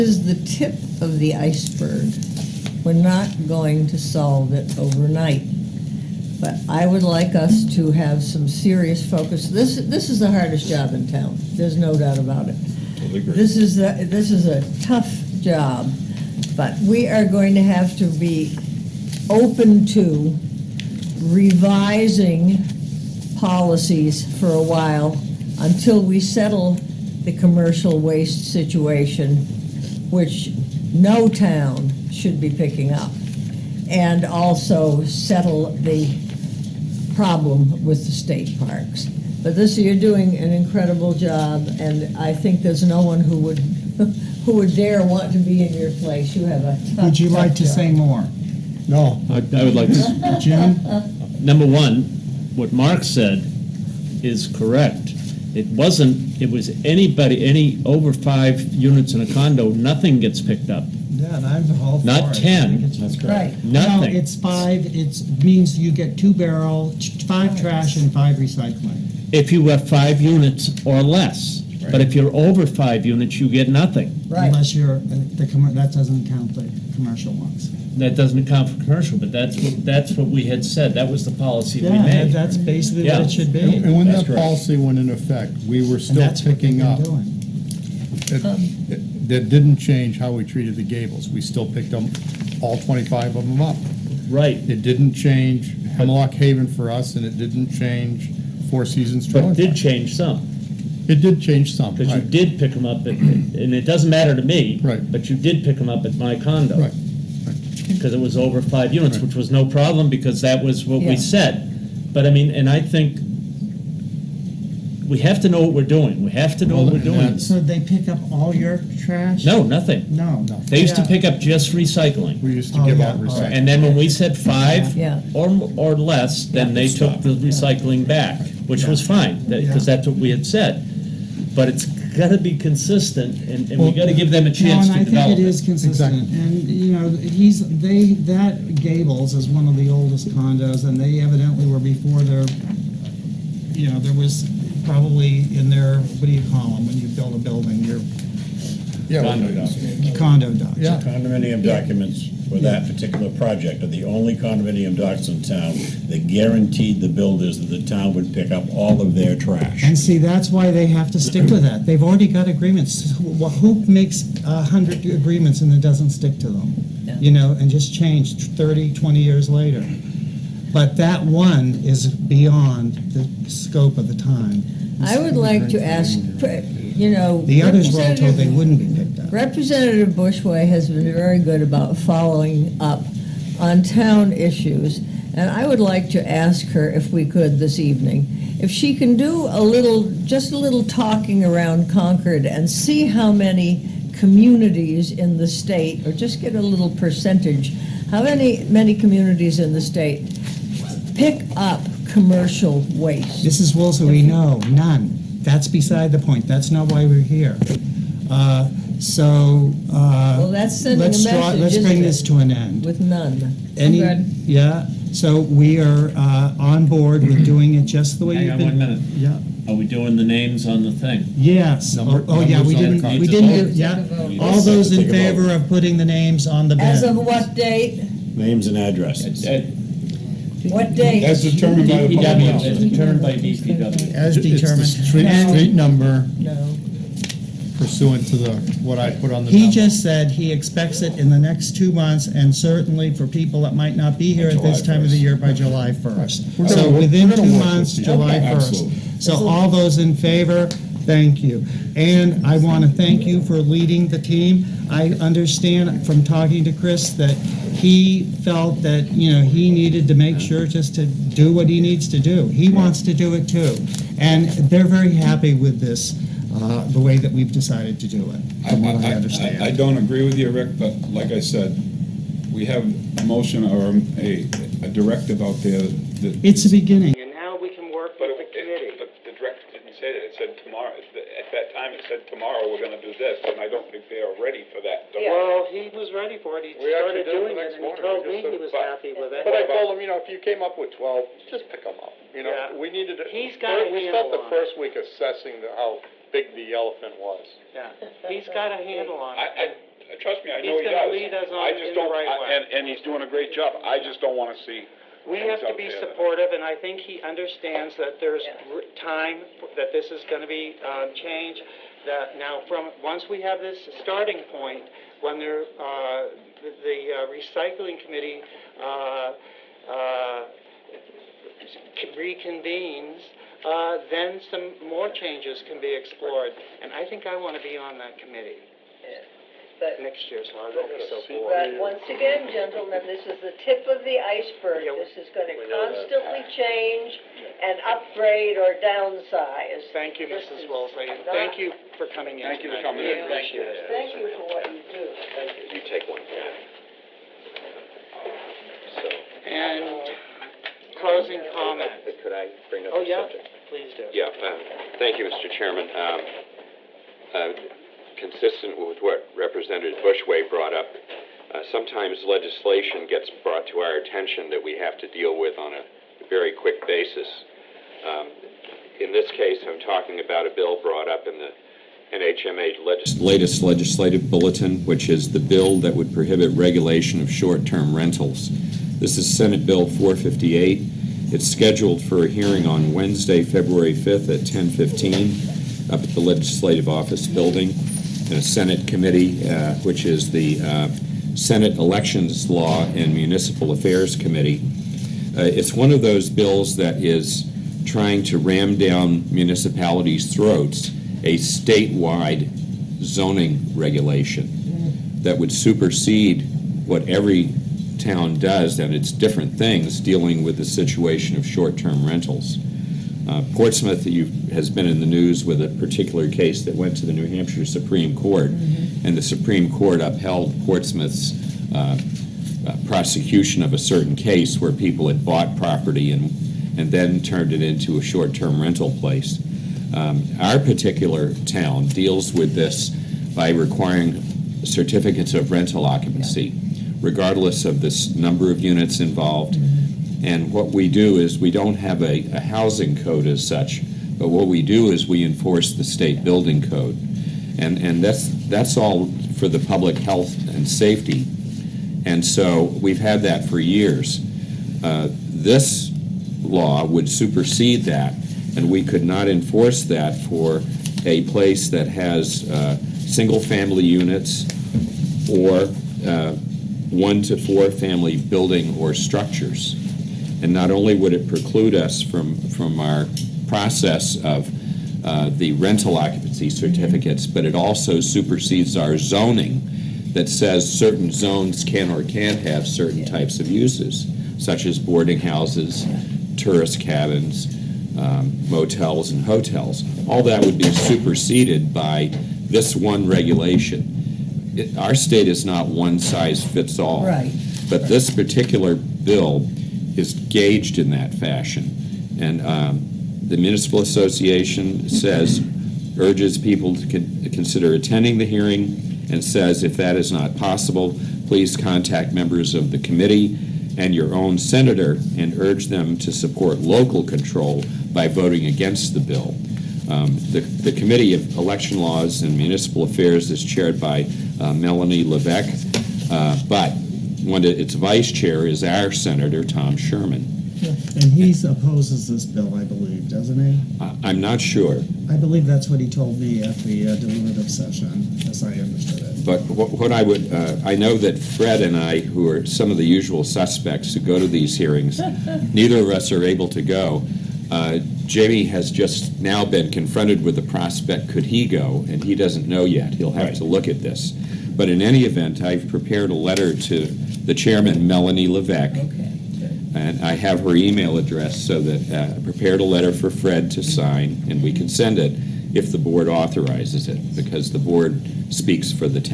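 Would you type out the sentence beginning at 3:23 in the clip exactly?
This is Woolsey, we know none.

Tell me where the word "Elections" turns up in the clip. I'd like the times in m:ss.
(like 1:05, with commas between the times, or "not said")
6:31, 8:41.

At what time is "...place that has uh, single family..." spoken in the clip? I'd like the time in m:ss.
7:41.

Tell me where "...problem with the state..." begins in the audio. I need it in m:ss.
0:37.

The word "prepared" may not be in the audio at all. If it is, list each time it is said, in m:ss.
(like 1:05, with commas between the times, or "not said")
9:15, 9:22.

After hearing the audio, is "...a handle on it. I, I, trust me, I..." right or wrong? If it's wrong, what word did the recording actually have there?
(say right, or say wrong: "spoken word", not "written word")
right.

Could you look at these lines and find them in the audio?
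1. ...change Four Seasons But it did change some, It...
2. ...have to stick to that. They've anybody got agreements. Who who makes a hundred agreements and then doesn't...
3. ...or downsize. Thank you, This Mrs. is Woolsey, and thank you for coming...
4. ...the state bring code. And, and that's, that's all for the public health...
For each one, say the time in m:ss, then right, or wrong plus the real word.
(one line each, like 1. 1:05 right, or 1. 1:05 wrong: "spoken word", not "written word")
1. 1:37 right
2. 2:40 wrong: "already", not "anybody"
3. 5:38 right
4. 7:25 wrong: "building", not "bring".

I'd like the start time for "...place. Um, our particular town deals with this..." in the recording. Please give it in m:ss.
7:08.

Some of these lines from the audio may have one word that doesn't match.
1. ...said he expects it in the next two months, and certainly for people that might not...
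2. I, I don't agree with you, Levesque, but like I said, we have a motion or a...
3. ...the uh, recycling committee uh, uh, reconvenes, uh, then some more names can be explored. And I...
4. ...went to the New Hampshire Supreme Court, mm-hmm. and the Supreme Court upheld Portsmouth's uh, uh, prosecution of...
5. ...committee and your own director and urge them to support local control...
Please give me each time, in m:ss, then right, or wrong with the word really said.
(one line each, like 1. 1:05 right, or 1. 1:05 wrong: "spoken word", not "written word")
1. 4:00 right
2. 4:29 wrong: "Rick", not "Levesque"
3. 5:16 wrong: "changes", not "names"
4. 6:56 right
5. 8:32 wrong: "senator", not "director".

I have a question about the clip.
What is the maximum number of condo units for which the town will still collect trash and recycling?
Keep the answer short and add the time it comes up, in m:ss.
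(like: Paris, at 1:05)
5, at 1:09.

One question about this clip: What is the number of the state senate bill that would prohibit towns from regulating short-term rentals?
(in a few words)
458.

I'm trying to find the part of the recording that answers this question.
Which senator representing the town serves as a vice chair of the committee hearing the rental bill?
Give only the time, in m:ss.
8:49.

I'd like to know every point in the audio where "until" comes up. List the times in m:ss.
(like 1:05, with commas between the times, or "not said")
0:25.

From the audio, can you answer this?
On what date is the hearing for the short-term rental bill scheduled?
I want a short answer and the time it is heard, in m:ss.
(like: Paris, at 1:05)
February 5th, at 6:23.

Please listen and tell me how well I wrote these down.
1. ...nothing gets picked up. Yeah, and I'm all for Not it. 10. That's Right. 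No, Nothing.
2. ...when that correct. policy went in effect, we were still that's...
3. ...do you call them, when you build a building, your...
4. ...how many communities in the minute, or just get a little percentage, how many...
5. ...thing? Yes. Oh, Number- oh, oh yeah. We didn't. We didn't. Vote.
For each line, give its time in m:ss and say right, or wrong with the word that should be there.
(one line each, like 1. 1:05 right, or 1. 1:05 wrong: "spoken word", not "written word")
1. 0:59 right
2. 1:23 right
3. 2:26 right
4. 3:13 wrong: "state", not "minute"
5. 3:40 right.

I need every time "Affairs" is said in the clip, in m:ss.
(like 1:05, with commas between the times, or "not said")
6:33, 8:42.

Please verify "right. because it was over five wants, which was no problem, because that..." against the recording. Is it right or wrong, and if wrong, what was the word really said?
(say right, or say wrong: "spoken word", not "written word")
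wrong: "units", not "wants".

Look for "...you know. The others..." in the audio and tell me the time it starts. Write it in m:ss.
2:56.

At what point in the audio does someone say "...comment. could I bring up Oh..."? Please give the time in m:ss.
5:51.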